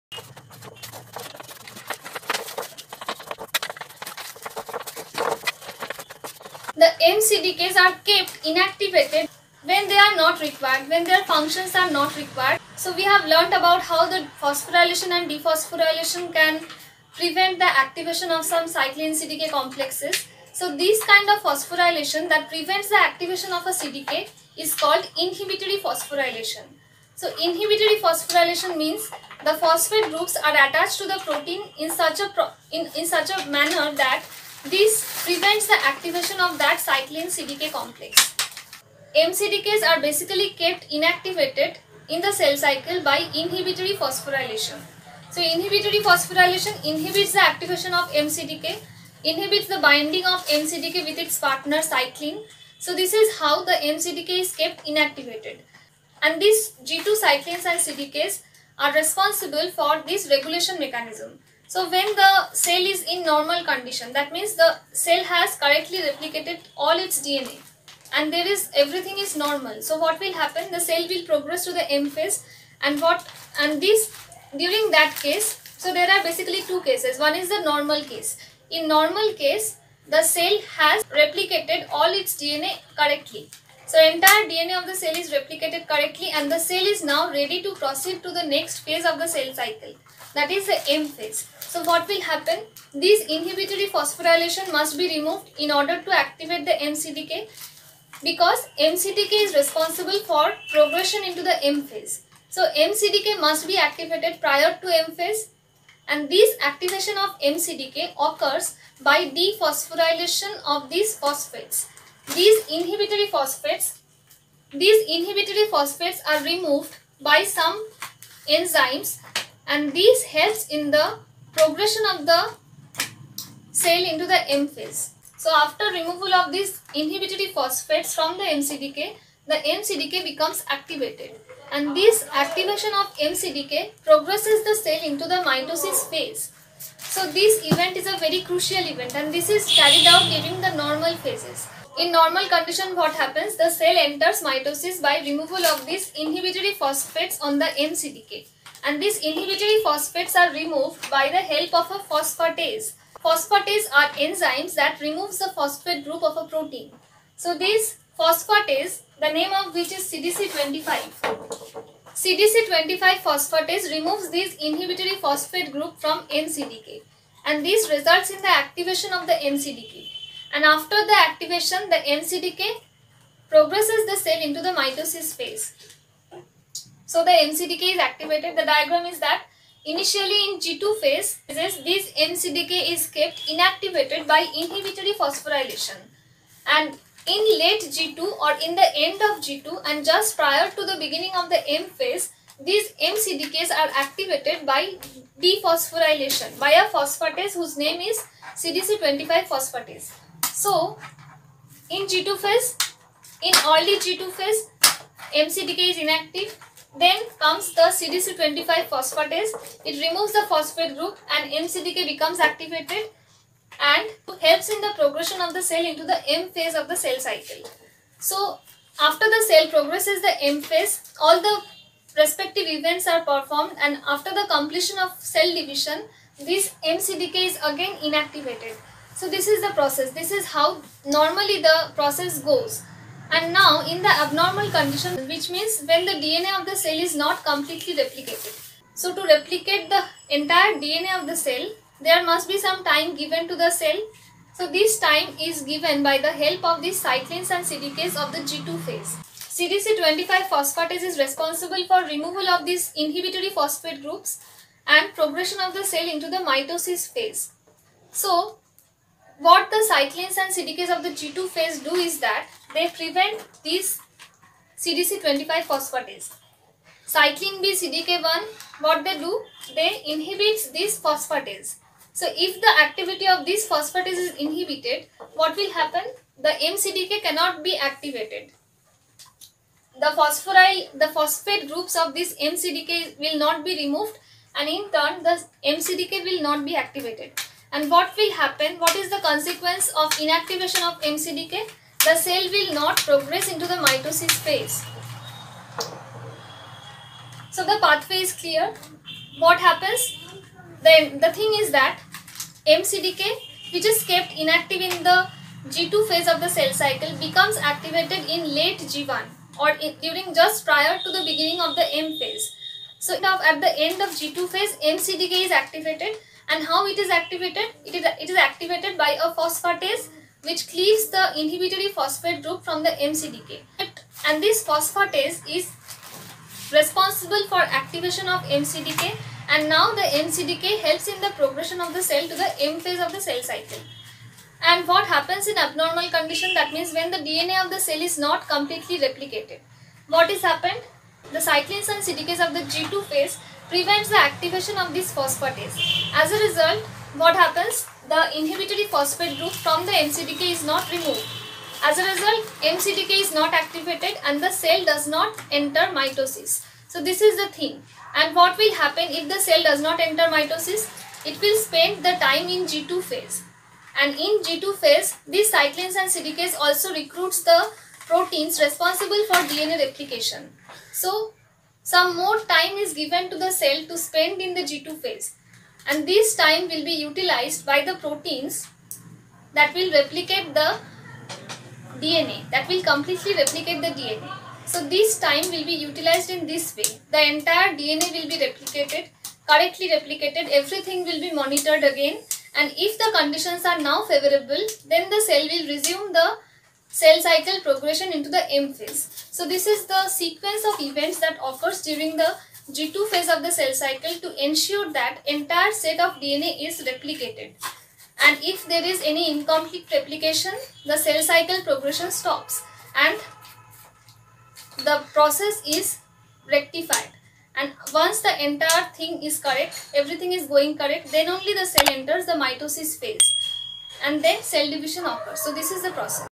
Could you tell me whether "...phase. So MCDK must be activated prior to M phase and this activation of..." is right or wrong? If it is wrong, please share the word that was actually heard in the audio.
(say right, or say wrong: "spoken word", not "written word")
right.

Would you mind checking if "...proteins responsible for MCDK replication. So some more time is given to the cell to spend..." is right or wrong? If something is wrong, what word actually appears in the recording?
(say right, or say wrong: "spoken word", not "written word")
wrong: "DNA", not "MCDK".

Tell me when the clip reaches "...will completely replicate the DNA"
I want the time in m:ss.
6:22.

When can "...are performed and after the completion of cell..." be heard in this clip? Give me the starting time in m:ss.
3:43.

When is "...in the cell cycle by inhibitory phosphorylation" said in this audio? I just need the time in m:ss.
0:42.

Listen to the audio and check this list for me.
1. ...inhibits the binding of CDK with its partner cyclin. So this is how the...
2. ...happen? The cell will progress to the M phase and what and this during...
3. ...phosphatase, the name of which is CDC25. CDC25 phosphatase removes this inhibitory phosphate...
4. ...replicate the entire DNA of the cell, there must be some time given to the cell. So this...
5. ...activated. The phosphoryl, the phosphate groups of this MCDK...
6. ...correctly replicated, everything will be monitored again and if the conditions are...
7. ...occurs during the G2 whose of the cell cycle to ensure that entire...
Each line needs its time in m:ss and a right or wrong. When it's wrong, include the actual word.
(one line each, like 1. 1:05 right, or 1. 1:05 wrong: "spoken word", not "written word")
1. 0:49 wrong: "MCDK", not "CDK"
2. 1:10 right
3. 2:38 right
4. 3:59 right
5. 4:37 right
6. 6:29 right
7. 6:41 wrong: "phase", not "whose".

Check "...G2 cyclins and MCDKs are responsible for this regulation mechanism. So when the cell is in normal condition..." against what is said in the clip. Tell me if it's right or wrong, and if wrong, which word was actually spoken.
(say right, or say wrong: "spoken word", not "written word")
wrong: "CDKs", not "MCDKs".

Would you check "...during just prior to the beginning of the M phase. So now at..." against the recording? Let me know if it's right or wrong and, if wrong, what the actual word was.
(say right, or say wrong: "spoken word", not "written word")
right.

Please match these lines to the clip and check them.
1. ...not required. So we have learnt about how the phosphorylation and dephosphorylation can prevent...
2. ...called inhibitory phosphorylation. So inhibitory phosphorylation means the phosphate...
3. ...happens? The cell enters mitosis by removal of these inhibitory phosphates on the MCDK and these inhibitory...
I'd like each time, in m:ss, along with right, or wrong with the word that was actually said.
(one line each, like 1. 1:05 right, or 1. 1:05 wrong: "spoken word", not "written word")
1. 0:11 right
2. 0:24 right
3. 2:23 right.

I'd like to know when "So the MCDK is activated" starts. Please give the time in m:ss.
2:57.